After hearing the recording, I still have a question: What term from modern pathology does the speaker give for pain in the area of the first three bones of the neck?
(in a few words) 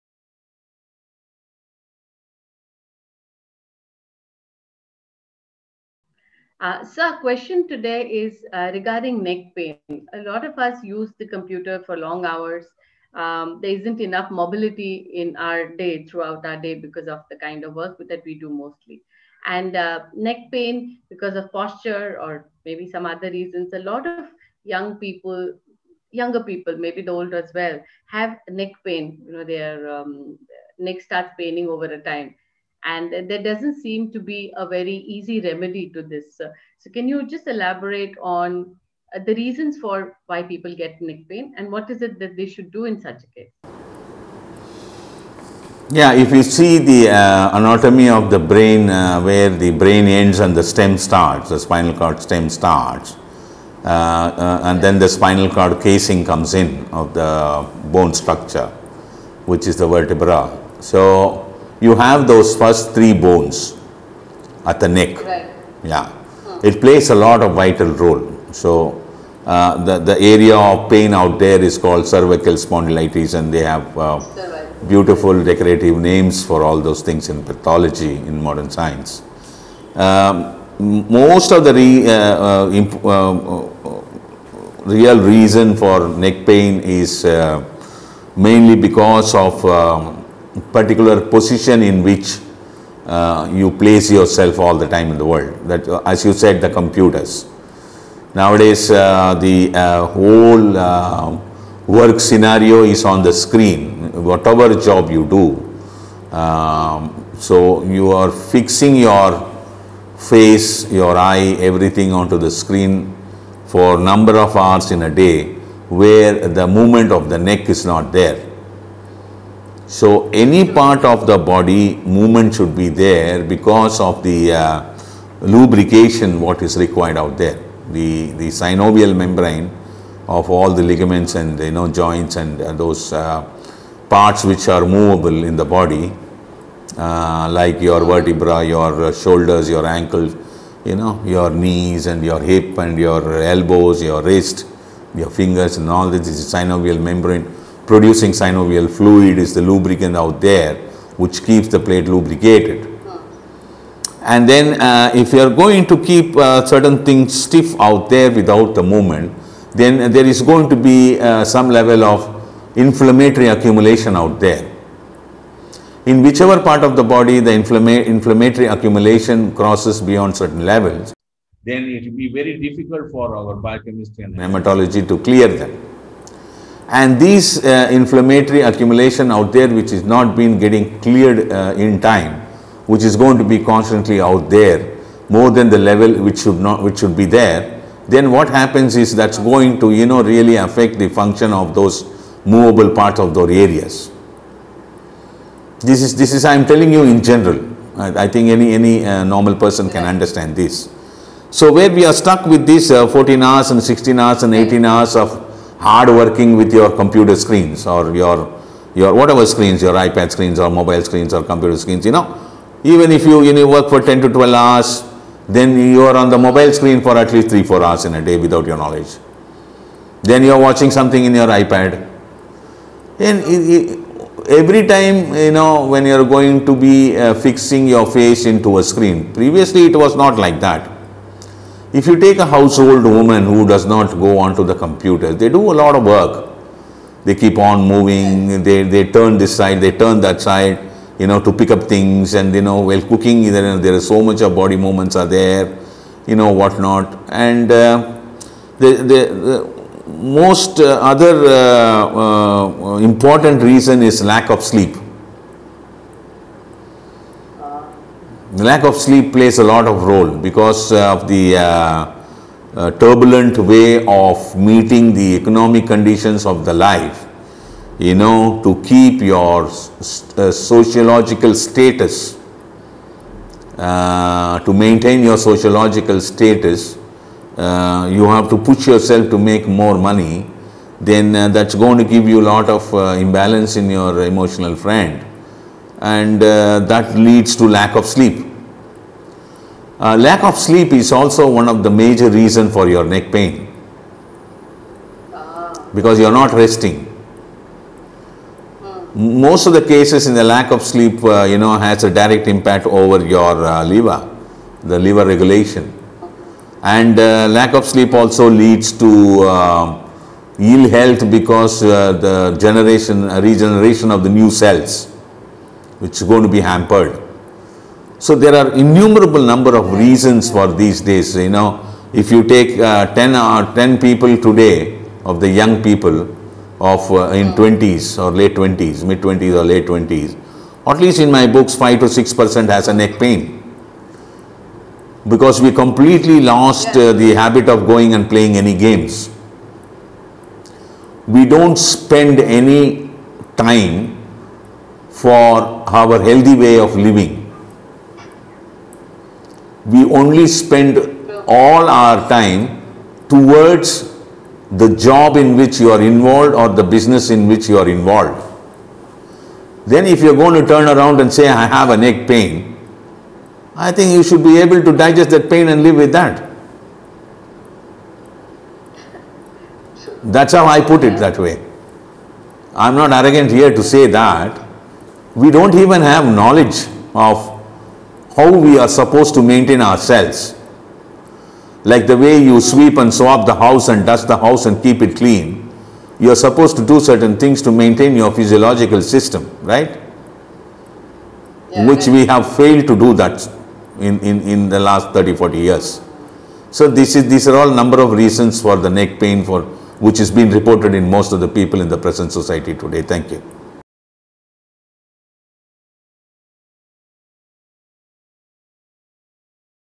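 cervical spondylitis.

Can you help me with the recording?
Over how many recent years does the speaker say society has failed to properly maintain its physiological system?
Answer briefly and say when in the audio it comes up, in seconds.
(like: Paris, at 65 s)
30-40 years, at 395 s.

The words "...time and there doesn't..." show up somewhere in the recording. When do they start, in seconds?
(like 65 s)
32 s.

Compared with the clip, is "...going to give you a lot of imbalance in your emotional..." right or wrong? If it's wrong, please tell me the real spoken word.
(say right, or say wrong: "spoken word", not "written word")
right.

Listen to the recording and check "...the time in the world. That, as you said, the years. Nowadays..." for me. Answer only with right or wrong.
wrong.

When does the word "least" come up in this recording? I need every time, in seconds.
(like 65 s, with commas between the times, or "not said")
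217 s, 330 s.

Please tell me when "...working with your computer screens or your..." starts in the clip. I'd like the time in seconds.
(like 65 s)
206 s.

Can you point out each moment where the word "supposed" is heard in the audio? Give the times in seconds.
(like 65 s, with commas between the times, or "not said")
378 s, 386 s.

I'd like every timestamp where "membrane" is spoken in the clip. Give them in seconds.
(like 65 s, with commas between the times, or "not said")
129 s, 146 s.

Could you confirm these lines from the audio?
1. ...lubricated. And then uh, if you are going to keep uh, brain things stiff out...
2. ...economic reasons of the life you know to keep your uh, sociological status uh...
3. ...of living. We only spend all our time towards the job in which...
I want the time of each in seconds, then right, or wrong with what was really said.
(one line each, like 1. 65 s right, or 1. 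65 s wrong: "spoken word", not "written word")
1. 152 s wrong: "certain", not "brain"
2. 265 s wrong: "conditions", not "reasons"
3. 346 s right.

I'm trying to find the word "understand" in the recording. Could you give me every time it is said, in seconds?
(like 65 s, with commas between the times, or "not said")
200 s.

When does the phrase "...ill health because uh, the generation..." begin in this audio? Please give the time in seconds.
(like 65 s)
310 s.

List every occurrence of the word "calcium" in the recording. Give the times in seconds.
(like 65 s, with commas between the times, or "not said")
not said.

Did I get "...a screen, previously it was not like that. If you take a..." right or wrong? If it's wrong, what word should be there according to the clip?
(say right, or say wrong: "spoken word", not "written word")
right.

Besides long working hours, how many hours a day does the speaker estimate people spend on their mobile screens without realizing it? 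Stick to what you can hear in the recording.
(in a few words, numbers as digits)
3-4 hours.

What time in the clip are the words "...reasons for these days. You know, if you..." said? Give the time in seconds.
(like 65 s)
319 s.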